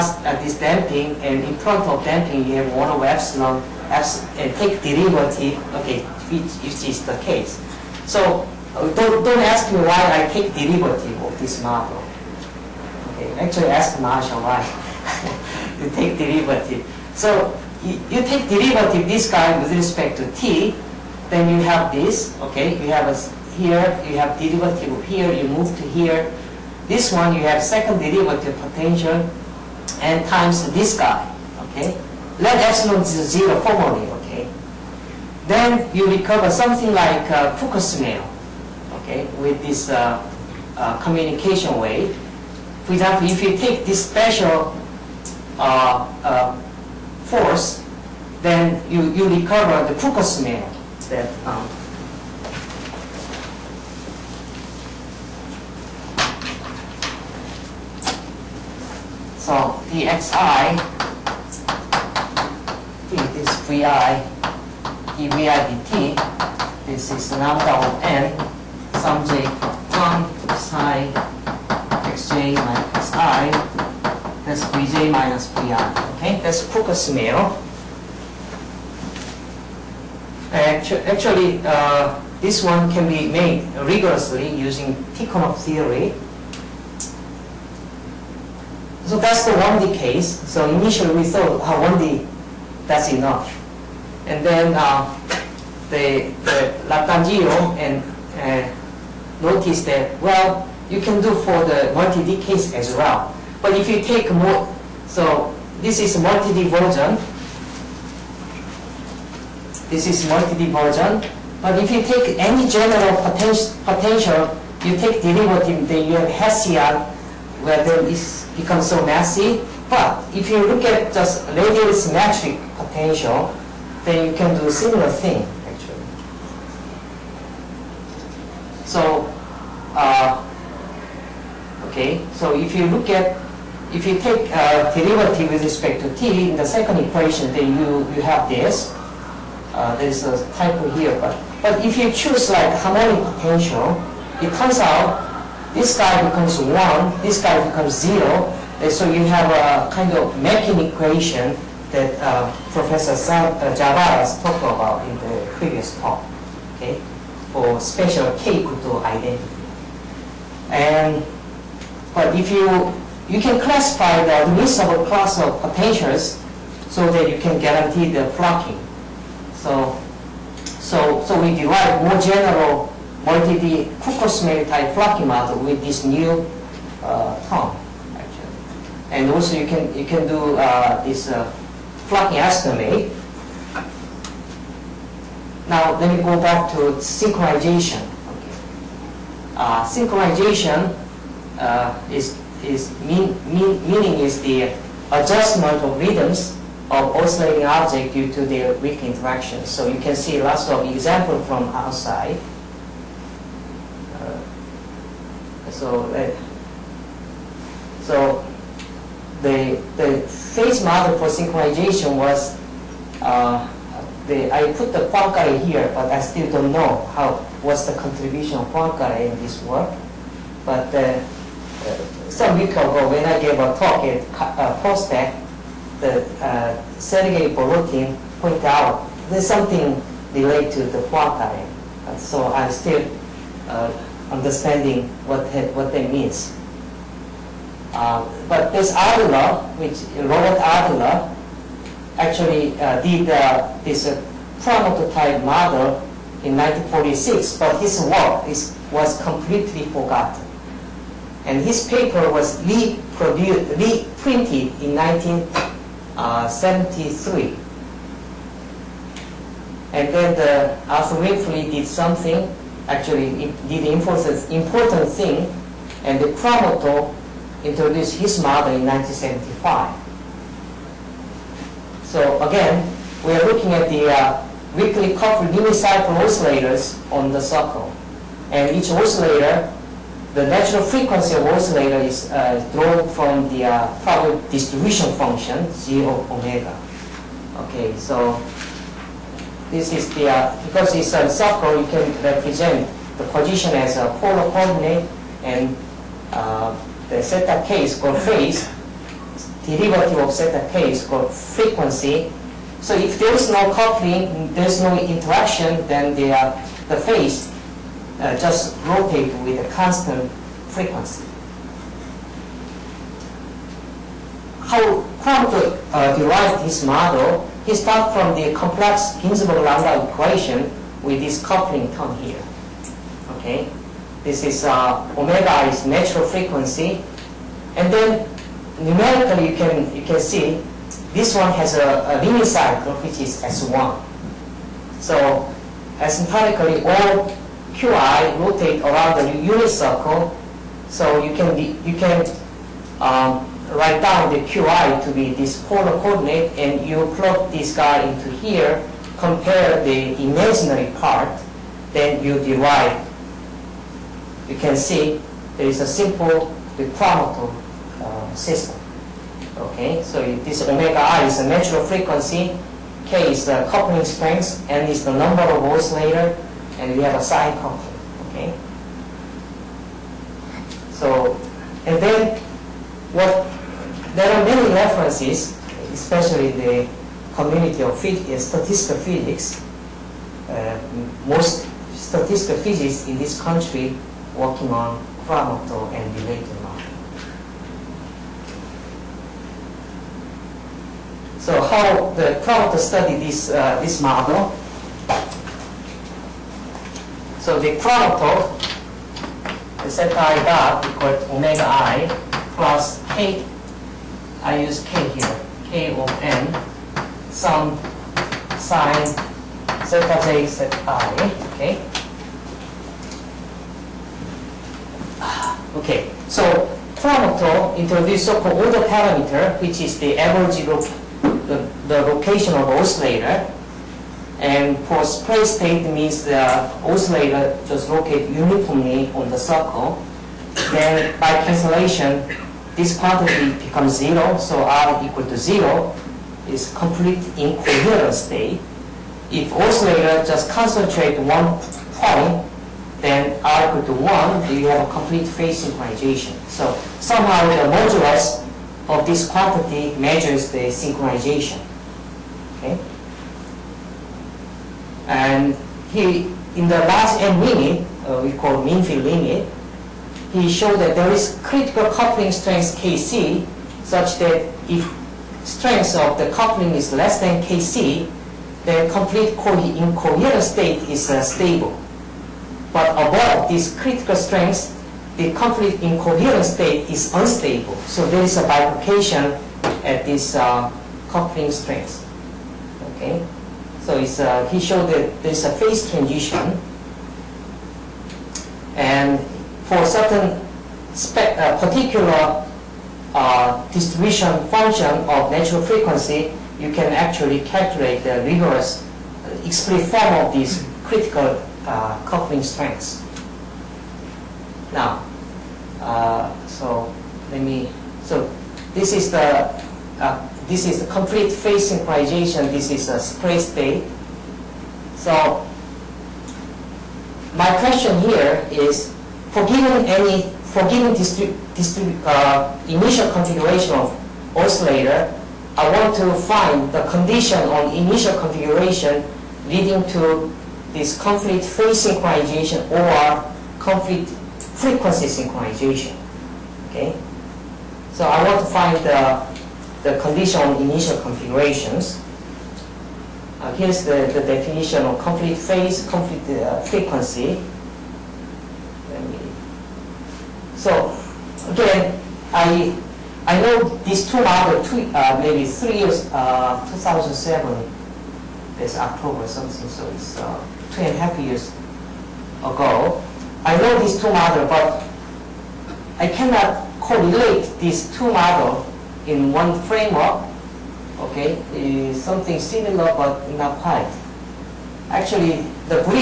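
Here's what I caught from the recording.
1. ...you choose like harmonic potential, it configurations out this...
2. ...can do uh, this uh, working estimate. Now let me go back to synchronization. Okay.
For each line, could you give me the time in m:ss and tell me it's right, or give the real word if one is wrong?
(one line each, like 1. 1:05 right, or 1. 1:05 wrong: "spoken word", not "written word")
1. 2:21 wrong: "turns", not "configurations"
2. 3:00 wrong: "flocking", not "working".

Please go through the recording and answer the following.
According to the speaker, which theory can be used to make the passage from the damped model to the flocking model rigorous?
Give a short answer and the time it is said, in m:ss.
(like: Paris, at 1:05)
Tikhonov theory, at 1:25.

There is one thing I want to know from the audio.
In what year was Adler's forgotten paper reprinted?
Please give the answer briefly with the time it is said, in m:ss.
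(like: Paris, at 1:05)
1973, at 4:14.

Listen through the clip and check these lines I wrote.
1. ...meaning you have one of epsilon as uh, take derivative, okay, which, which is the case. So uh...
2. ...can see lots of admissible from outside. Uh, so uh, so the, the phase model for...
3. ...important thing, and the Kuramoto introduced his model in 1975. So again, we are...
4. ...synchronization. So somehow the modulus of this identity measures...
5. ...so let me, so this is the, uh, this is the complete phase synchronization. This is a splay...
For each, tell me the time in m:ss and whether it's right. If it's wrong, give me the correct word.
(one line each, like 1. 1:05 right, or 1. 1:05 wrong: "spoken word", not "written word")
1. 0:02 wrong: "damping", not "meaning"
2. 3:19 wrong: "example", not "admissible"
3. 4:24 right
4. 7:25 wrong: "quantity", not "identity"
5. 8:26 right.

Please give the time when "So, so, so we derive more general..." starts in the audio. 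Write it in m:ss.
2:49.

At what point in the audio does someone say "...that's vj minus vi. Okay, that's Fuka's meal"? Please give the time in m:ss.
1:14.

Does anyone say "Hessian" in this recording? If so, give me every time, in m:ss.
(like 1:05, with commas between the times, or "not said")
1:56.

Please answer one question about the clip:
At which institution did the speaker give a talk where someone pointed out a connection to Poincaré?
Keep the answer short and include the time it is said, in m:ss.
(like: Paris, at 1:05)
POSTECH, at 3:44.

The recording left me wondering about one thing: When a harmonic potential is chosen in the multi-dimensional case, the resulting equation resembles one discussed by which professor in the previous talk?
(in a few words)
Javaras.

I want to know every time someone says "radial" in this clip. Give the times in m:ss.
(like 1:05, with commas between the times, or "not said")
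2:01.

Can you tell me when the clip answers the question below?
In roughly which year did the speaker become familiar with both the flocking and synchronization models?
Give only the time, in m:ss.
9:16.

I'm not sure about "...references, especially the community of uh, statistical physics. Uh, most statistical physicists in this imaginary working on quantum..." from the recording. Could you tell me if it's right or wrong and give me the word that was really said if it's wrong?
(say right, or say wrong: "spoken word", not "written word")
wrong: "country", not "imaginary".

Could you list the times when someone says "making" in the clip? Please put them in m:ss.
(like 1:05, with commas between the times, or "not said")
2:30.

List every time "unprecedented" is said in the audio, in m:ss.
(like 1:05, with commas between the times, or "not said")
not said.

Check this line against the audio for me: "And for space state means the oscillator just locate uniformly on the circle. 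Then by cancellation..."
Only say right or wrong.
right.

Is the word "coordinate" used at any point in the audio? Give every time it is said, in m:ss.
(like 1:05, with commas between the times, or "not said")
4:54, 5:46.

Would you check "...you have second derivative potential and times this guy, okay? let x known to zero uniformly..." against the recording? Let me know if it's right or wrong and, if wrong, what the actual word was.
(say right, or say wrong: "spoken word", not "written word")
wrong: "formally", not "uniformly".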